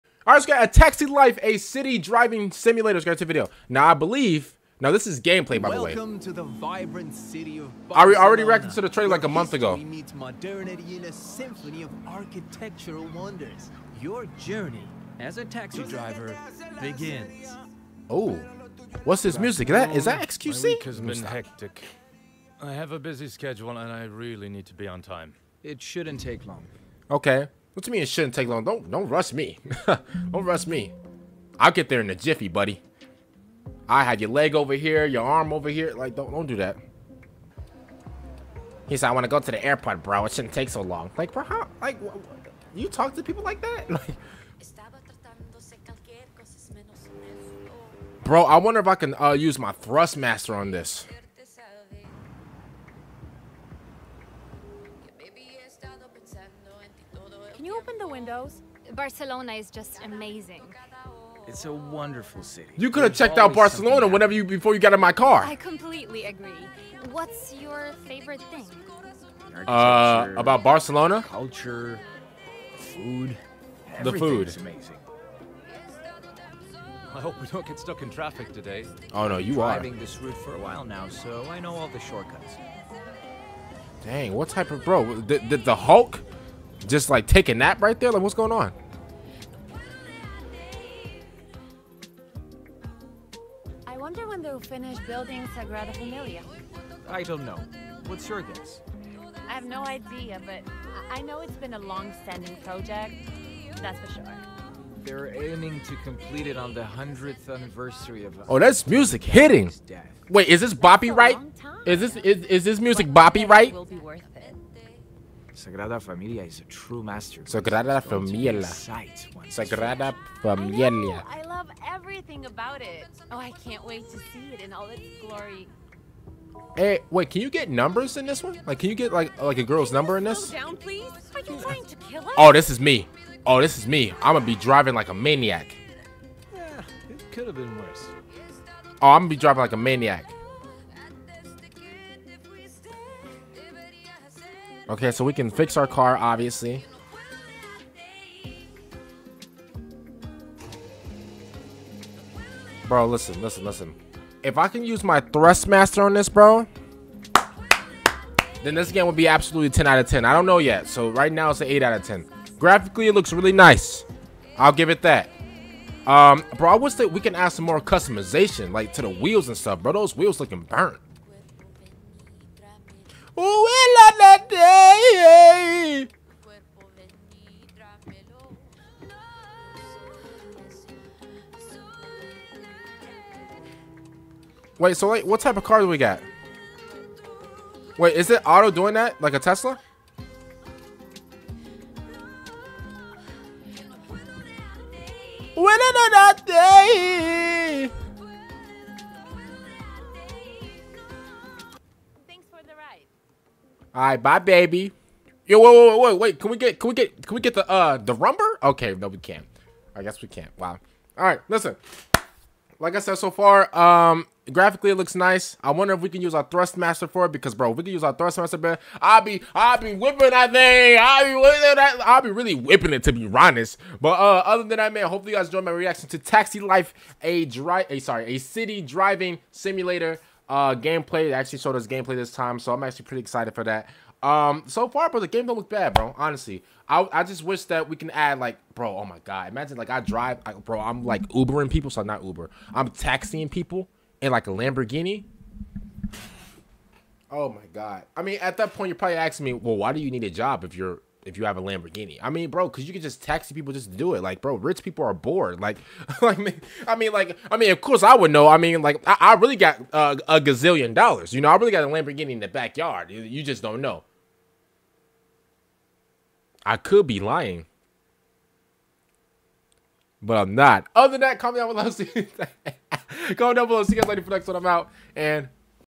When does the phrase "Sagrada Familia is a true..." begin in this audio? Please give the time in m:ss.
1:55.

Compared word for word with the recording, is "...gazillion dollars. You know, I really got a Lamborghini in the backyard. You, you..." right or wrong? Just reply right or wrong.
right.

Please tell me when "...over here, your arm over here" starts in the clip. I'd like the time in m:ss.
0:34.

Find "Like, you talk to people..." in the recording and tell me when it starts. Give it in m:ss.
0:41.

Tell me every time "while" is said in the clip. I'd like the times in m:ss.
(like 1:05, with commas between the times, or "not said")
1:20.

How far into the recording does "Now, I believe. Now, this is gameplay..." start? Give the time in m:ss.
0:03.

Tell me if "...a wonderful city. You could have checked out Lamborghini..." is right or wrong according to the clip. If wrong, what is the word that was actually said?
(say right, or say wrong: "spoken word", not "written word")
wrong: "Barcelona", not "Lamborghini".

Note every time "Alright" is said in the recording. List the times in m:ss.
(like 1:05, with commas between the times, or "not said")
3:23, 3:31.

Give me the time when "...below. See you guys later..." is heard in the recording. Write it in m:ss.
4:33.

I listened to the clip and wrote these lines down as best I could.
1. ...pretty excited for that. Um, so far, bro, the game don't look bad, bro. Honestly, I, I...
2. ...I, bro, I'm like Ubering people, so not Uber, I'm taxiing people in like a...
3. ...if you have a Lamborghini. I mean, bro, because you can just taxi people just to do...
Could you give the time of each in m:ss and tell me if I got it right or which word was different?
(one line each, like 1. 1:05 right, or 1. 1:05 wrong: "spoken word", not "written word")
1. 3:53 right
2. 4:00 right
3. 4:11 right.